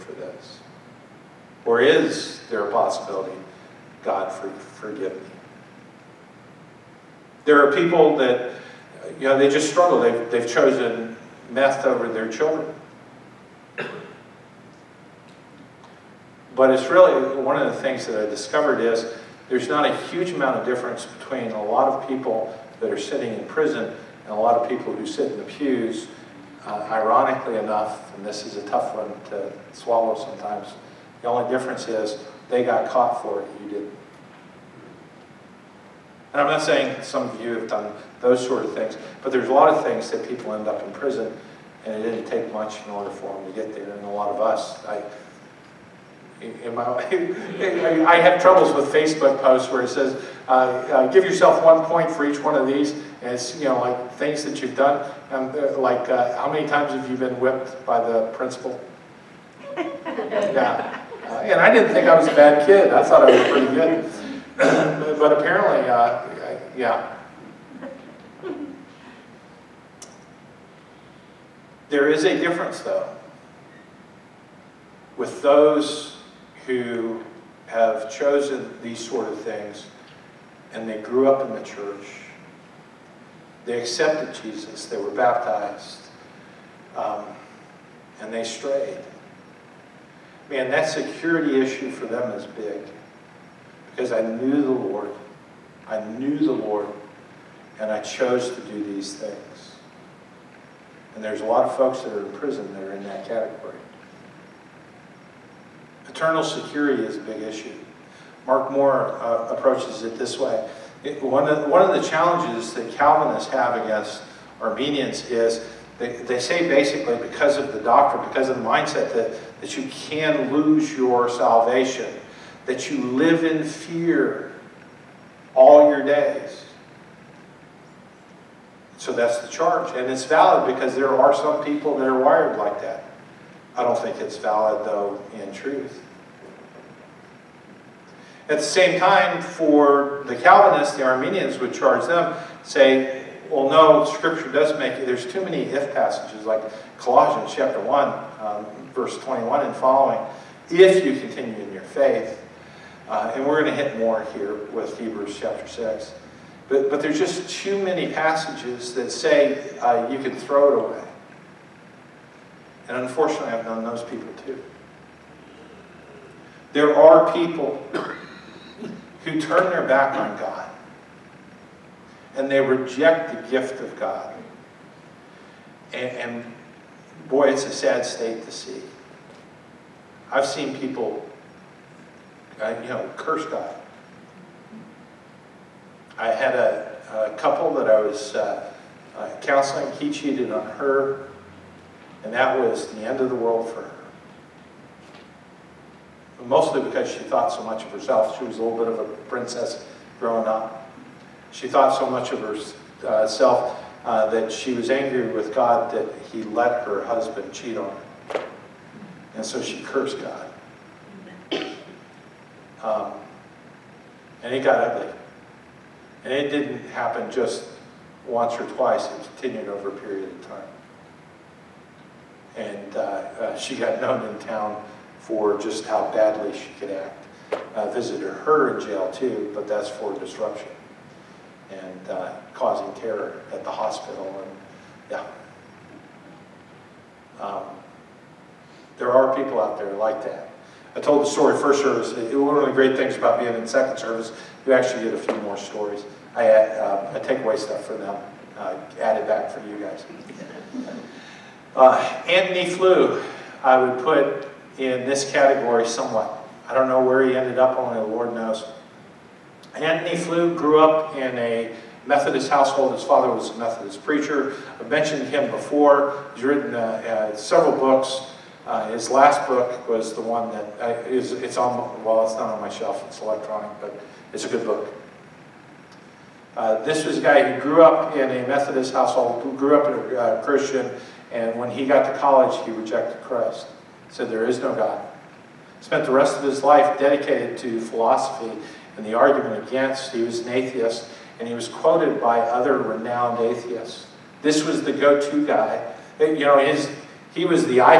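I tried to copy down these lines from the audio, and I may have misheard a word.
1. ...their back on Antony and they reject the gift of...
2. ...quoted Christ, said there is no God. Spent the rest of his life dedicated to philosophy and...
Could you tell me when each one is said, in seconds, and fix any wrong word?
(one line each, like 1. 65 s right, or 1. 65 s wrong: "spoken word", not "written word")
1. 169 s wrong: "God", not "Antony"
2. 282 s wrong: "rejected", not "quoted".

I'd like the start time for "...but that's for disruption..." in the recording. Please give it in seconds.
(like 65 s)
229 s.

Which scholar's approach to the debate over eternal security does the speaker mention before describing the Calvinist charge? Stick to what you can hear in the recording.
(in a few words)
Mark Moore.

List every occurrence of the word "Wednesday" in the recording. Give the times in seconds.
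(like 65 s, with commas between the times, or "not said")
not said.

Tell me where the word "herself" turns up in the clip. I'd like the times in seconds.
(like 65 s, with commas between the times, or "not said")
197 s, 203 s.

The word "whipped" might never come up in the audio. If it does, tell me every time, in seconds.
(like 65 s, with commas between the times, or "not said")
57 s.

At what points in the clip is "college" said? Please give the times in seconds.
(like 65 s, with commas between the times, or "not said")
282 s.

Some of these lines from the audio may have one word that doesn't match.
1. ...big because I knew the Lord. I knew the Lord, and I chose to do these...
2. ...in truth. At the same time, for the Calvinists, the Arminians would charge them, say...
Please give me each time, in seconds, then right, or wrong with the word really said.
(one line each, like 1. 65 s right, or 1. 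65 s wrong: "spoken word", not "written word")
1. 92 s right
2. 135 s right.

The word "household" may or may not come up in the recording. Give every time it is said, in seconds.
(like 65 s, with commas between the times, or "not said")
262 s, 278 s.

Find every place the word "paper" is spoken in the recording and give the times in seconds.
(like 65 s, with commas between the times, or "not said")
not said.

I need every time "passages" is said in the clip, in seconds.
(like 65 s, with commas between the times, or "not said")
145 s, 158 s.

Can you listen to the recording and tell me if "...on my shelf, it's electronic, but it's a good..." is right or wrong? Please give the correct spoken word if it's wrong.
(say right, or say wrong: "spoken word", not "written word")
right.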